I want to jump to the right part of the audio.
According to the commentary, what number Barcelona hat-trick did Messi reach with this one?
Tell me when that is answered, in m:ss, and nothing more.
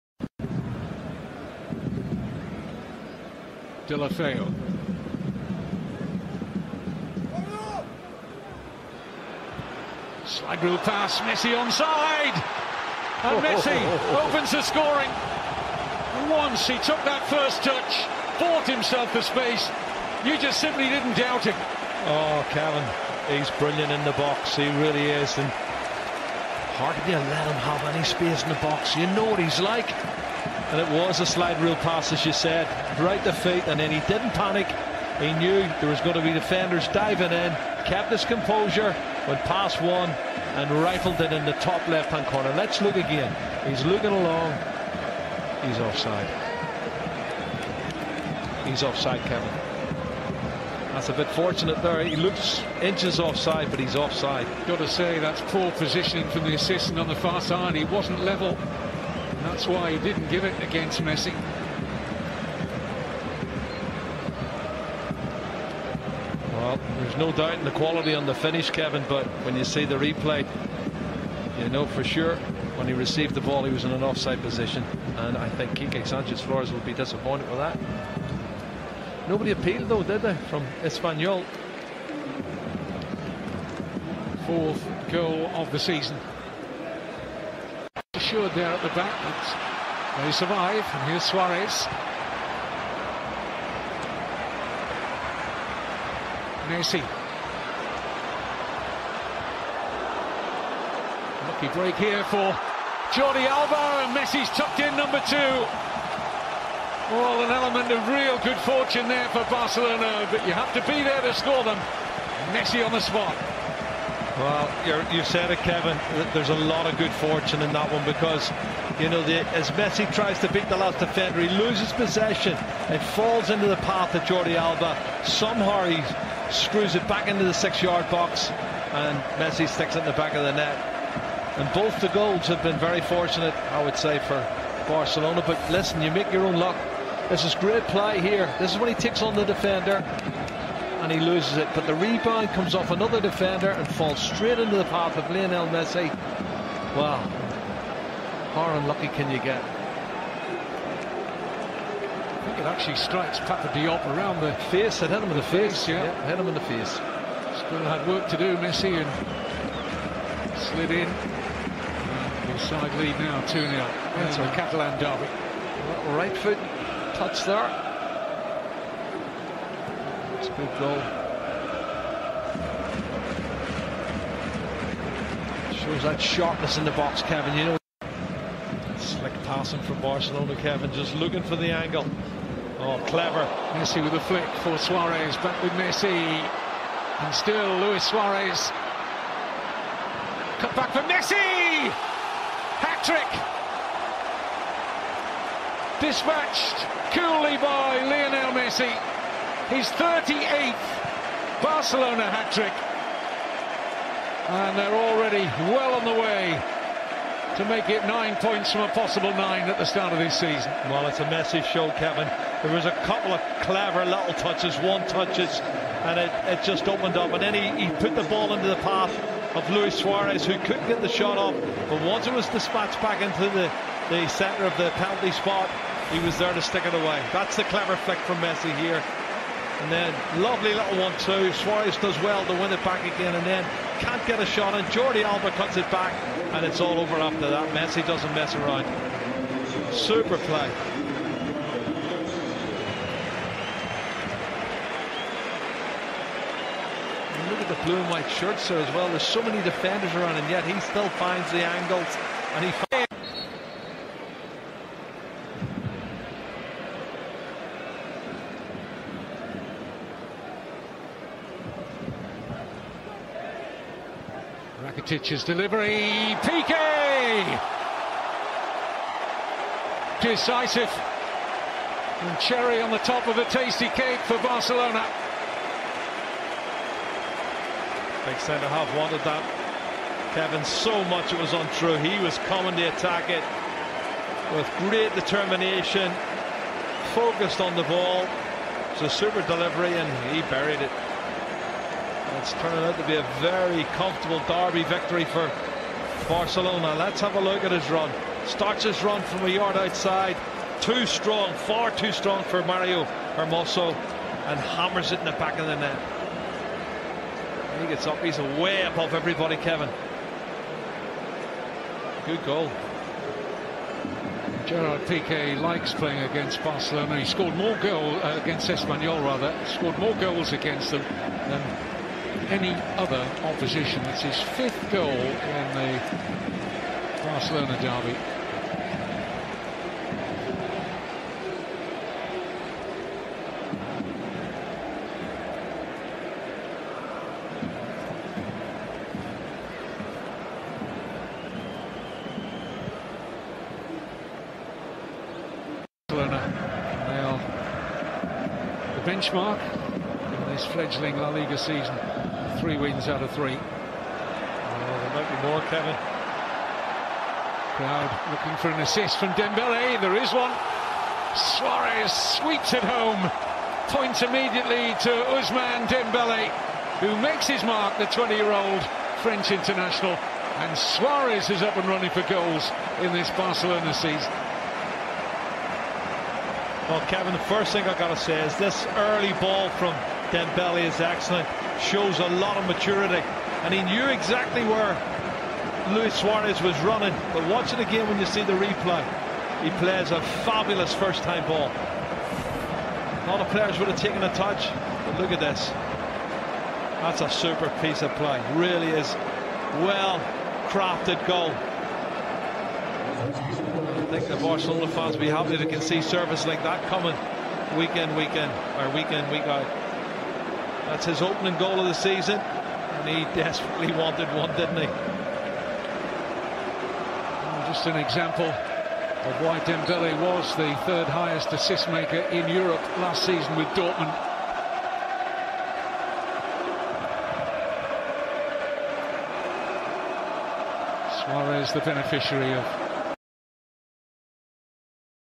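3:19.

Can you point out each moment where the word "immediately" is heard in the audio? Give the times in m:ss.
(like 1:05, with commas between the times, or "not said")
6:04.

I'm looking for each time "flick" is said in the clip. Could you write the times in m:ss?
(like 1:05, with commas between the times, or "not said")
3:04, 3:47.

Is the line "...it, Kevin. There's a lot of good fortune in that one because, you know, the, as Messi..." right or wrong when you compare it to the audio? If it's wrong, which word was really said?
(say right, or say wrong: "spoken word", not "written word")
right.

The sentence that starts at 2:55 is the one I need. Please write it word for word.
Shows that sharpness in the box, Kevin.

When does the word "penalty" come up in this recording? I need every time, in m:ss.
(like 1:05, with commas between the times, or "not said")
3:44.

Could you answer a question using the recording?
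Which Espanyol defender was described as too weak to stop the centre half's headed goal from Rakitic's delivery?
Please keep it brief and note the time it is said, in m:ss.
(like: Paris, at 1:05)
Mario Hermoso, at 5:02.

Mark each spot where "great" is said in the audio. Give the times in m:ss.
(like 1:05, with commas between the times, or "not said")
2:17, 4:44.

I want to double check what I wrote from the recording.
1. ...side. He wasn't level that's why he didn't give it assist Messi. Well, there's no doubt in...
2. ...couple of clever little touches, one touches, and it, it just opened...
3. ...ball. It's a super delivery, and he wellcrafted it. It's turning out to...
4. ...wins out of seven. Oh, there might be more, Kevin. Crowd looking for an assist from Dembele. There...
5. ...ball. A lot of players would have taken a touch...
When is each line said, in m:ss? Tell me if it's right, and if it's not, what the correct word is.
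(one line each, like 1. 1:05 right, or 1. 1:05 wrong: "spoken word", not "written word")
1. 0:57 wrong: "against", not "assist"
2. 3:33 right
3. 4:47 wrong: "buried", not "wellcrafted"
4. 5:52 wrong: "three", not "seven"
5. 6:31 right.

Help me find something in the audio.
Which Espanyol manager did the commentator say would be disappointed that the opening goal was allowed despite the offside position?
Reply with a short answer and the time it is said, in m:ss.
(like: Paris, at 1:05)
Quique Sanchez Flores, at 1:15.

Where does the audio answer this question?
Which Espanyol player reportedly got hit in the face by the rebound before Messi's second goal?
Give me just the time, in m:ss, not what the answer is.
2:33.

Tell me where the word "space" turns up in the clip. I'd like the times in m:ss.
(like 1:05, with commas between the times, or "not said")
0:19, 0:28.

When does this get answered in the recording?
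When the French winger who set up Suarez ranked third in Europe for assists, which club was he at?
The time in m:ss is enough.
7:03.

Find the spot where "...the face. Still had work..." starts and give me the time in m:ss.
2:36.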